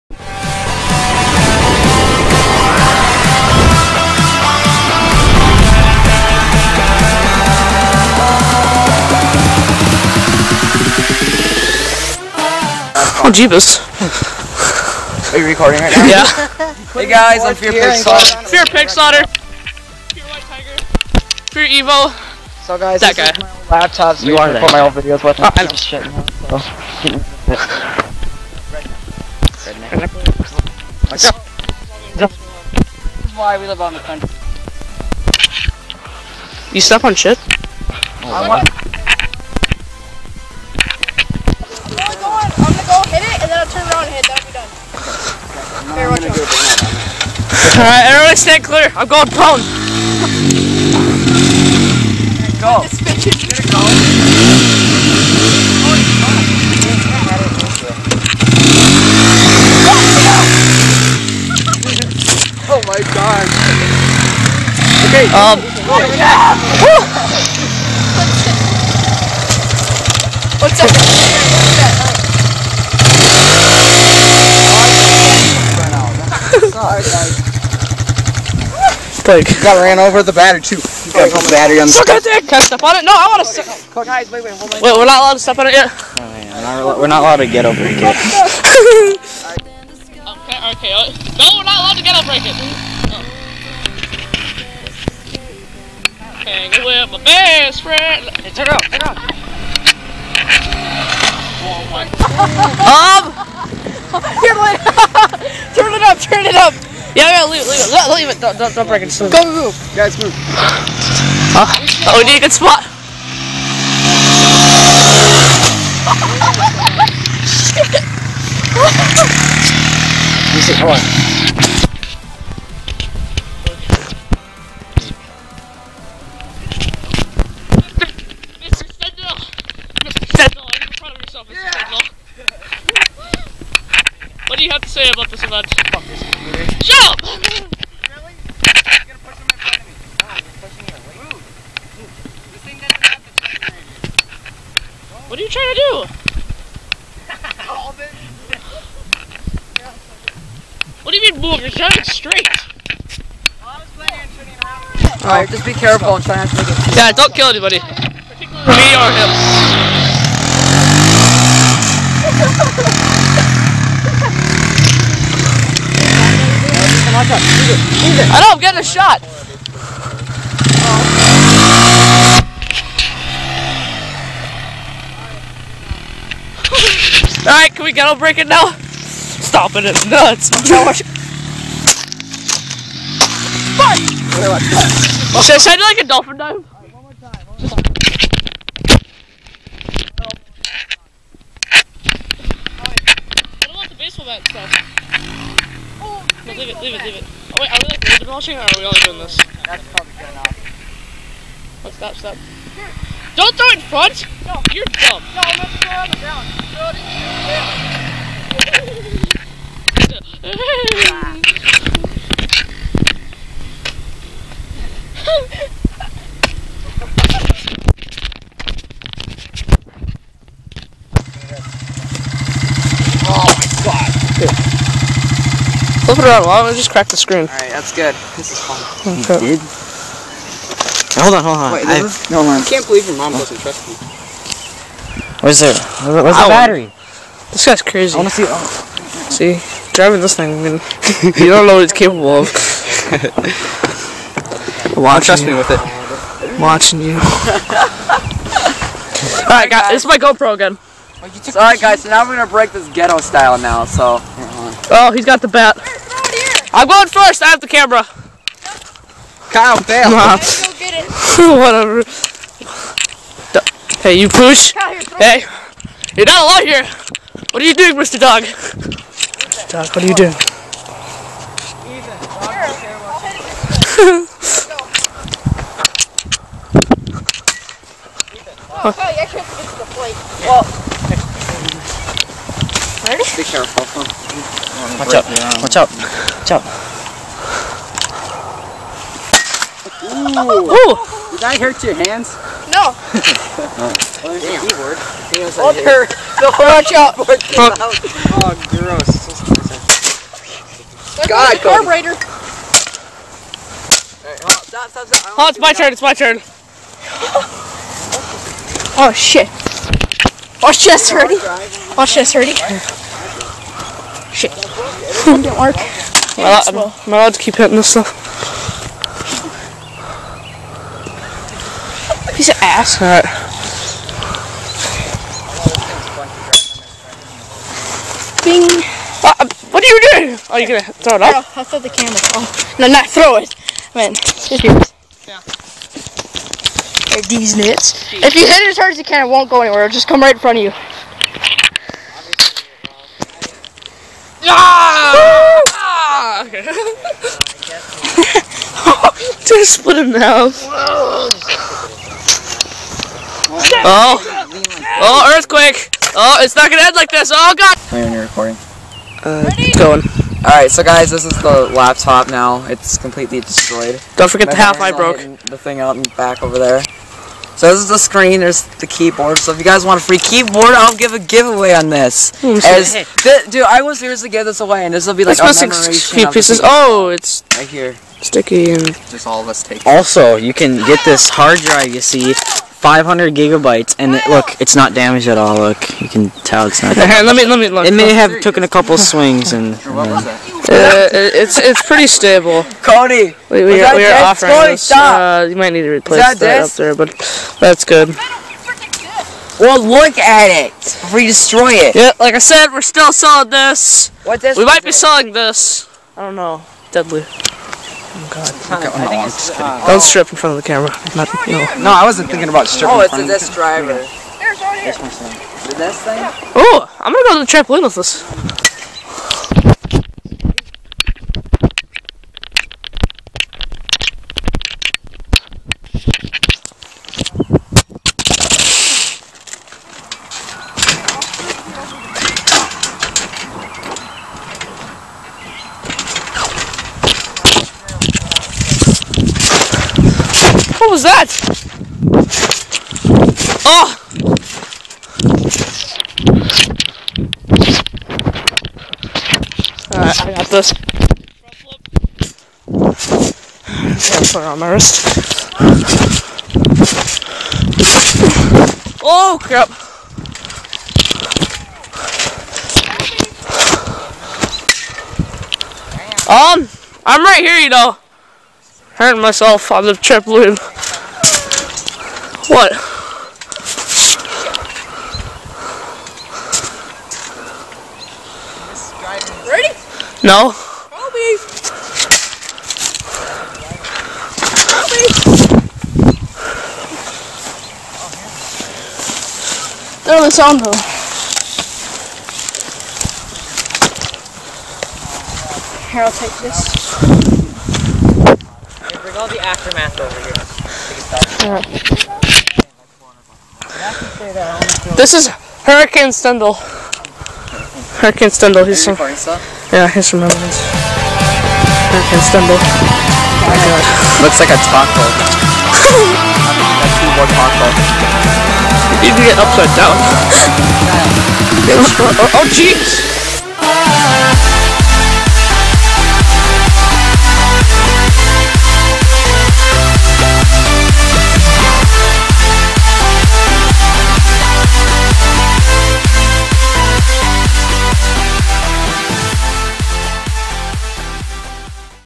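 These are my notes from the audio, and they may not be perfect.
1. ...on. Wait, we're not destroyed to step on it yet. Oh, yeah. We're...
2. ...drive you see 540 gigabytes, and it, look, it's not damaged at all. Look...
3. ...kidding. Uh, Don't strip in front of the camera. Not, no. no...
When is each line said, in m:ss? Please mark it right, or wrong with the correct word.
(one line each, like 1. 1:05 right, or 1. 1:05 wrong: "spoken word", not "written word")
1. 1:24 wrong: "allowed", not "destroyed"
2. 6:21 wrong: "500", not "540"
3. 6:49 right.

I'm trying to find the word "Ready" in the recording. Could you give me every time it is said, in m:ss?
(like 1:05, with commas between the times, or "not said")
7:59.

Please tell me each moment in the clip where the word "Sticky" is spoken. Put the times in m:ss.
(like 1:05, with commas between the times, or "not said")
6:18.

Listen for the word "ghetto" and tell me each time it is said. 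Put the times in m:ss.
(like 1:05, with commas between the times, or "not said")
2:58, 4:12.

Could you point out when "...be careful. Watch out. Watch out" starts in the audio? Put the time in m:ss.
4:43.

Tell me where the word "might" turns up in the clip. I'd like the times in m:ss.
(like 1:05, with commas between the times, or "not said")
6:35, 6:44.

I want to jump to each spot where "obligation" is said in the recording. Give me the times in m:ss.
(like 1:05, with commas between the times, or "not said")
not said.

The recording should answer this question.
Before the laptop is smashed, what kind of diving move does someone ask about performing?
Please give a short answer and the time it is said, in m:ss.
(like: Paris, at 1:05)
dolphin dive, at 3:06.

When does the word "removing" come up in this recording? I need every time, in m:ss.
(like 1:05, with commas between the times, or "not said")
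not said.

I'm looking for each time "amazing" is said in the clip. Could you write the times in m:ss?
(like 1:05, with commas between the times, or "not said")
not said.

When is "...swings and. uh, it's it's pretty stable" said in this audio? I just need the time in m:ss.
6:28.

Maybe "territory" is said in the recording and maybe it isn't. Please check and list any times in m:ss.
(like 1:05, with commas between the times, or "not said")
not said.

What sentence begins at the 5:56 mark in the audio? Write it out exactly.
Oh, it's not gonna end like this.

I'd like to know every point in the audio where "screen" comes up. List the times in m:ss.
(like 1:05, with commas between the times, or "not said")
3:47, 6:07.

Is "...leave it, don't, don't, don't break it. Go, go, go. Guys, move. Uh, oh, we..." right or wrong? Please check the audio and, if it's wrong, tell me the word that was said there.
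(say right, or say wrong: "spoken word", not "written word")
right.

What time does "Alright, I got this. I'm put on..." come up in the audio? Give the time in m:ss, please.
7:29.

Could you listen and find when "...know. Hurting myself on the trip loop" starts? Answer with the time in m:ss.
7:47.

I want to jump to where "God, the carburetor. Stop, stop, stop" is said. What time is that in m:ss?
5:01.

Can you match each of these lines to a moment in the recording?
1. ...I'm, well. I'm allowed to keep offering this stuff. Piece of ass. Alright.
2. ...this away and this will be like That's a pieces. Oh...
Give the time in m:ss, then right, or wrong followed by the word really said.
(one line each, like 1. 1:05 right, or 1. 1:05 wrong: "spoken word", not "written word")
1. 5:16 wrong: "hitting", not "offering"
2. 6:14 right.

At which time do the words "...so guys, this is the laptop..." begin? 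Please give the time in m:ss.
6:00.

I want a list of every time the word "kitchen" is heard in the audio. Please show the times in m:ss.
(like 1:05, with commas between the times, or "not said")
not said.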